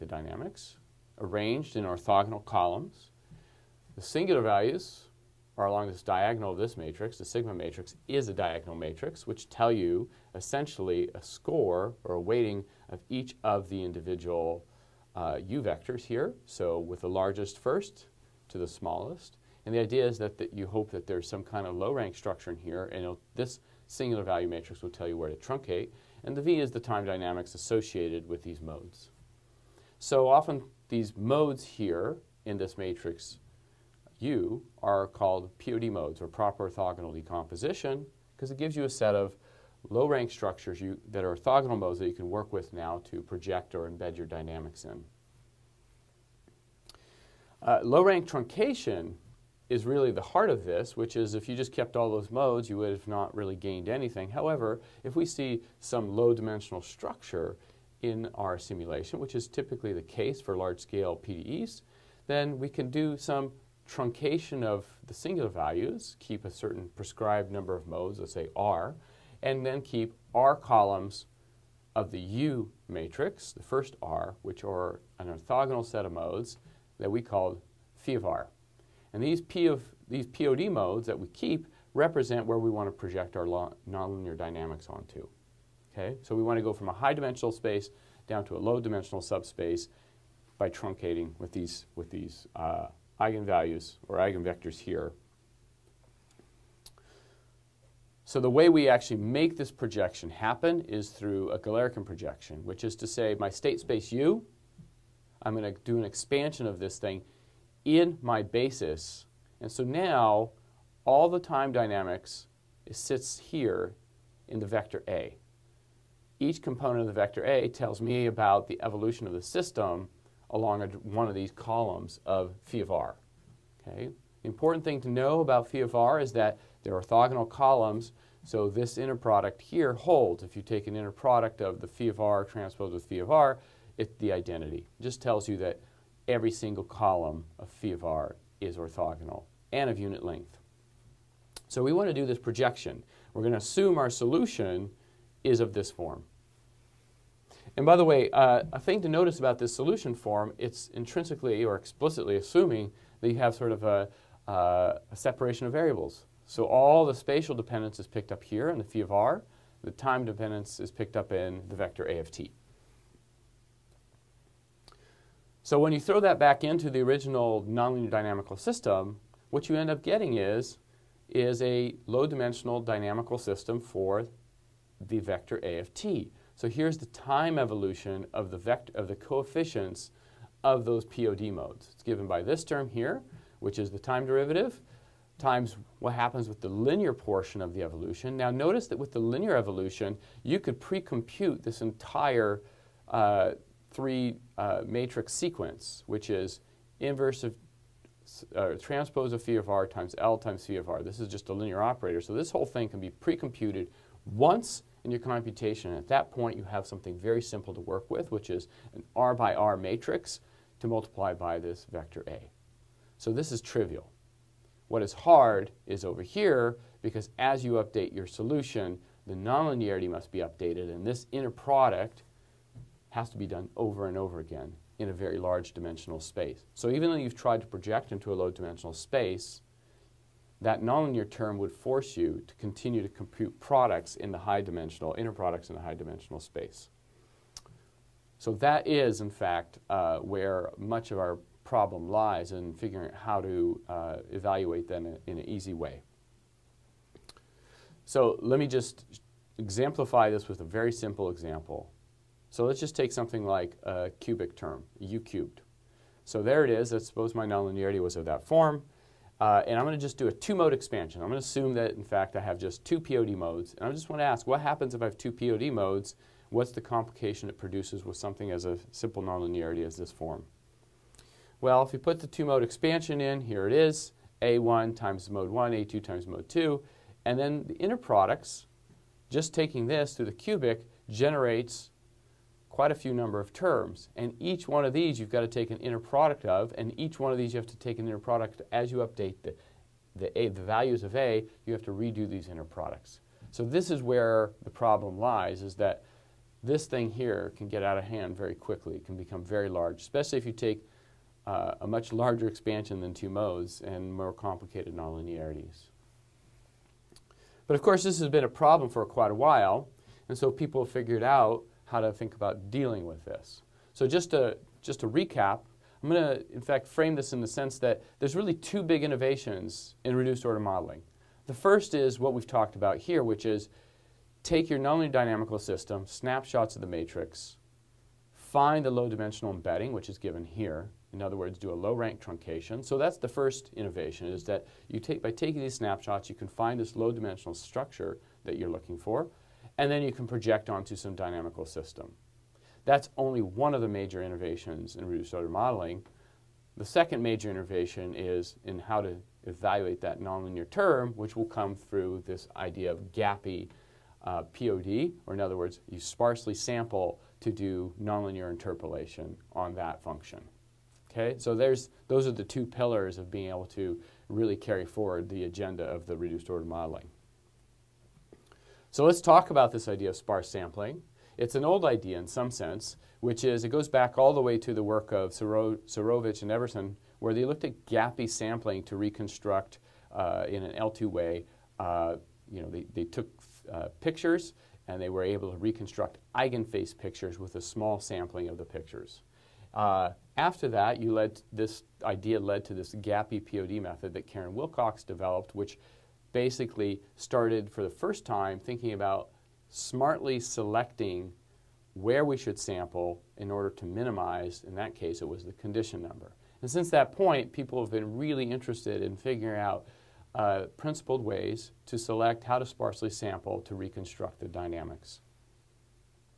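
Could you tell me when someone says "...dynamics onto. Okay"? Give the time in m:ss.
1:24.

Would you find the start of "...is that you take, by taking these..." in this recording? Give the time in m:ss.
5:34.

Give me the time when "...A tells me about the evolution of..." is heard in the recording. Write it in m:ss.
1:57.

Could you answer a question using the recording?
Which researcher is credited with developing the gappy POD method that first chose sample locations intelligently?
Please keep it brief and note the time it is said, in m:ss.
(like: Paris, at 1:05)
Karen Willcox, at 6:34.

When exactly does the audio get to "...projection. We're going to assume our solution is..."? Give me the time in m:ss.
2:22.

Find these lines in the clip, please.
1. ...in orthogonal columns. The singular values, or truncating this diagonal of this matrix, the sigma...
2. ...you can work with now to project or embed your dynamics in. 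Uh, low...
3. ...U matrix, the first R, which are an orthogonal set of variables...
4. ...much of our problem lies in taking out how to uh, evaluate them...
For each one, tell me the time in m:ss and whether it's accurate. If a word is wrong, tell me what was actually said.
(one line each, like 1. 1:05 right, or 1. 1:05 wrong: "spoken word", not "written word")
1. 0:01 wrong: "along", not "truncating"
2. 0:42 right
3. 1:12 wrong: "modes", not "variables"
4. 4:00 wrong: "figuring", not "taking".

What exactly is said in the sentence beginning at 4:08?
So let me just exemplify this with a very simple example.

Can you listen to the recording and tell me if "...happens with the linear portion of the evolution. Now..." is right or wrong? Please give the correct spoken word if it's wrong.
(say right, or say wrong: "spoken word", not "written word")
right.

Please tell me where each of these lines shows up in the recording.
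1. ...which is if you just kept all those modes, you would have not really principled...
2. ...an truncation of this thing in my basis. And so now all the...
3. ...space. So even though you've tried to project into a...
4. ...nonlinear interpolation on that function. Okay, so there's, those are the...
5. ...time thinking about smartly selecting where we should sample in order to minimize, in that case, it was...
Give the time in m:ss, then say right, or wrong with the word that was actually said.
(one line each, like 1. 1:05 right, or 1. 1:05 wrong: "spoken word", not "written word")
1. 0:50 wrong: "gained", not "principled"
2. 1:45 wrong: "expansion", not "truncation"
3. 3:46 right
4. 5:58 right
5. 6:38 right.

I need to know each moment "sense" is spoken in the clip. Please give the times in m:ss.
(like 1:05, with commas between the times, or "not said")
5:17, 6:12.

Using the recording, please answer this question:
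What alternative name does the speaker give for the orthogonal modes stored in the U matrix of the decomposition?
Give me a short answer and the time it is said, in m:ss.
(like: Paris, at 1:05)
Proper orthogonal decomposition, at 0:36.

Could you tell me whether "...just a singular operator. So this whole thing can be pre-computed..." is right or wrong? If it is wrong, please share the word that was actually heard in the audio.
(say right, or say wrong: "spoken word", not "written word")
wrong: "linear", not "singular".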